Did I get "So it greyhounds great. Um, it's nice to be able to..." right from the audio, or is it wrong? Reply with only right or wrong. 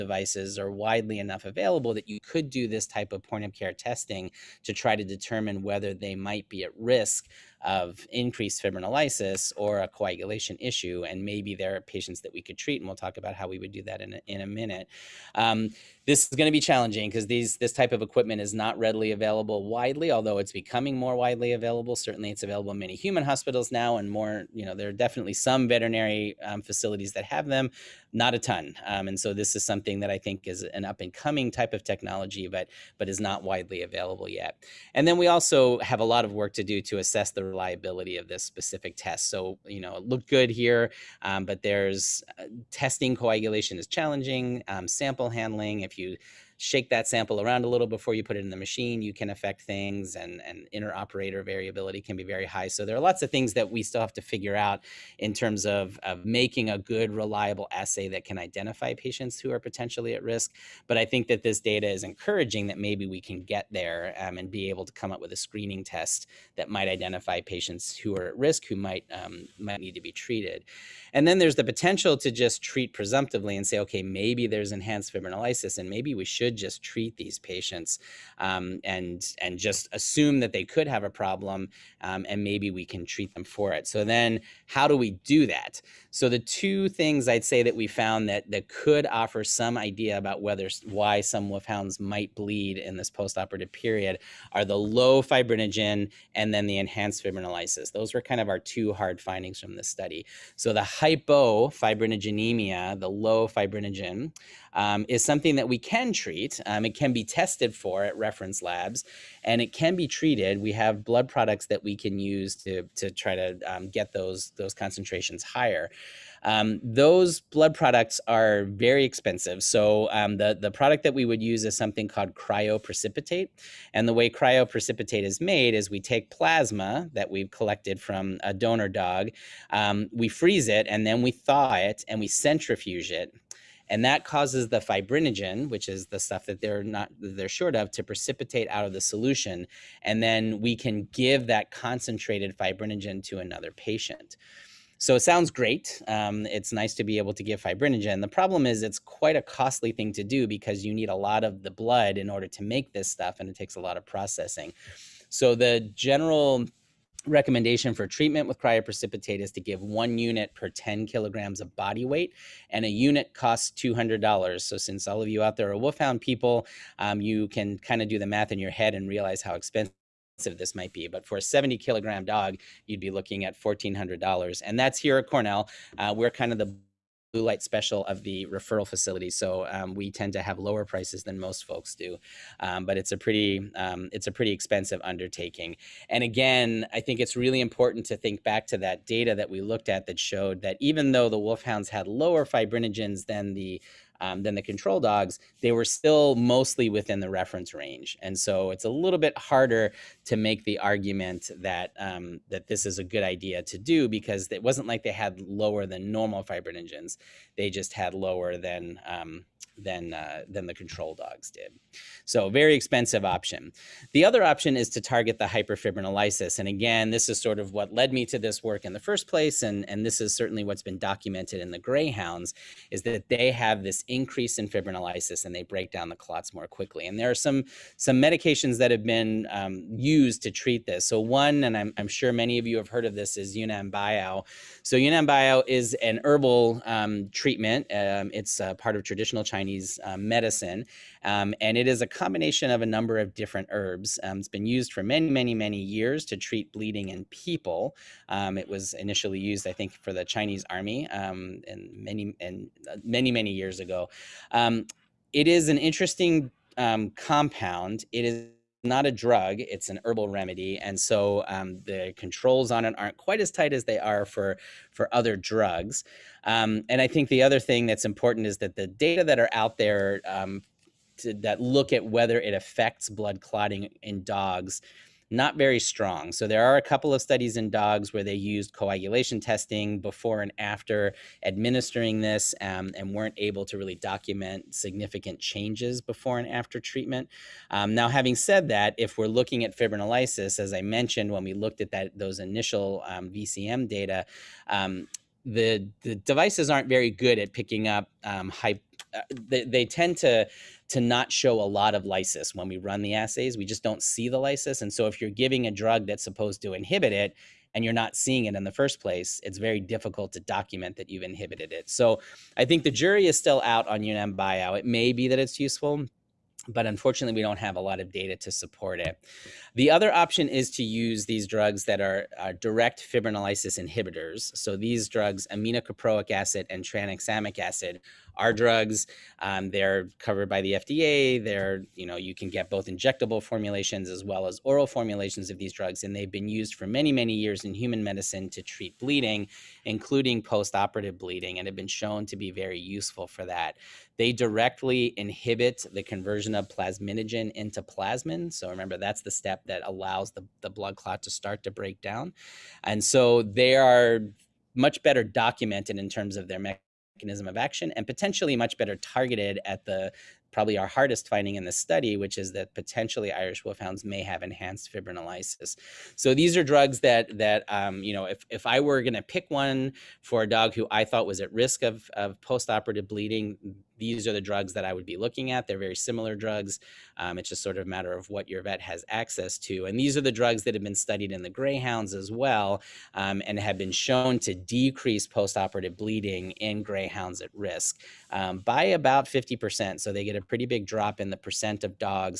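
wrong.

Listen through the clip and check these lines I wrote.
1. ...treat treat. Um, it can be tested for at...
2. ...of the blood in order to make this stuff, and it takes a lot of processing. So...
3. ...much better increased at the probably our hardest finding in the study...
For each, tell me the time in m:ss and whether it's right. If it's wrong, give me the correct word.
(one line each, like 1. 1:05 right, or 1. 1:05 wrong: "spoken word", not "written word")
1. 1:46 right
2. 2:31 right
3. 5:58 wrong: "targeted", not "increased".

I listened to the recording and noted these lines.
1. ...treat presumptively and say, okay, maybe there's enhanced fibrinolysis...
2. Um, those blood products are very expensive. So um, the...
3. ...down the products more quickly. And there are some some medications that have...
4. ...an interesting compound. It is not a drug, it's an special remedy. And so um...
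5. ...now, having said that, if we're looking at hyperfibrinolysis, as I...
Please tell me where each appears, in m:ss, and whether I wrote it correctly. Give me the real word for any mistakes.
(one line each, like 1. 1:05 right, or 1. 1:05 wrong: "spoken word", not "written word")
1. 1:12 right
2. 1:56 right
3. 3:45 wrong: "clots", not "products"
4. 4:15 wrong: "herbal", not "special"
5. 4:47 wrong: "fibrinolysis", not "hyperfibrinolysis".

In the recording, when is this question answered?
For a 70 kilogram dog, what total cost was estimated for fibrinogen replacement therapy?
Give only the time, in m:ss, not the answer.
2:53.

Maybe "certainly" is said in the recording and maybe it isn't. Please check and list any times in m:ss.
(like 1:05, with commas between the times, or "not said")
0:21, 3:40.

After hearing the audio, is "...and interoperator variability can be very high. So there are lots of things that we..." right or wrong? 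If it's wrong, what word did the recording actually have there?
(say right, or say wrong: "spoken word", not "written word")
right.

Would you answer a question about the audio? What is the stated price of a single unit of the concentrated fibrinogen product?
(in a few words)
$200.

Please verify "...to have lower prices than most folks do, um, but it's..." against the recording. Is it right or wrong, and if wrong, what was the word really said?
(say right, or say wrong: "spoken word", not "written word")
right.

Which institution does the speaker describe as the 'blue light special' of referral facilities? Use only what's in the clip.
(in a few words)
Cornell.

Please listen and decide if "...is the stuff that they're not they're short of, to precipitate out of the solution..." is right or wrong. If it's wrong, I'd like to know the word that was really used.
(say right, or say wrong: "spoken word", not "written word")
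right.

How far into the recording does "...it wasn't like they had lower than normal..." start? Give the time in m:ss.
3:24.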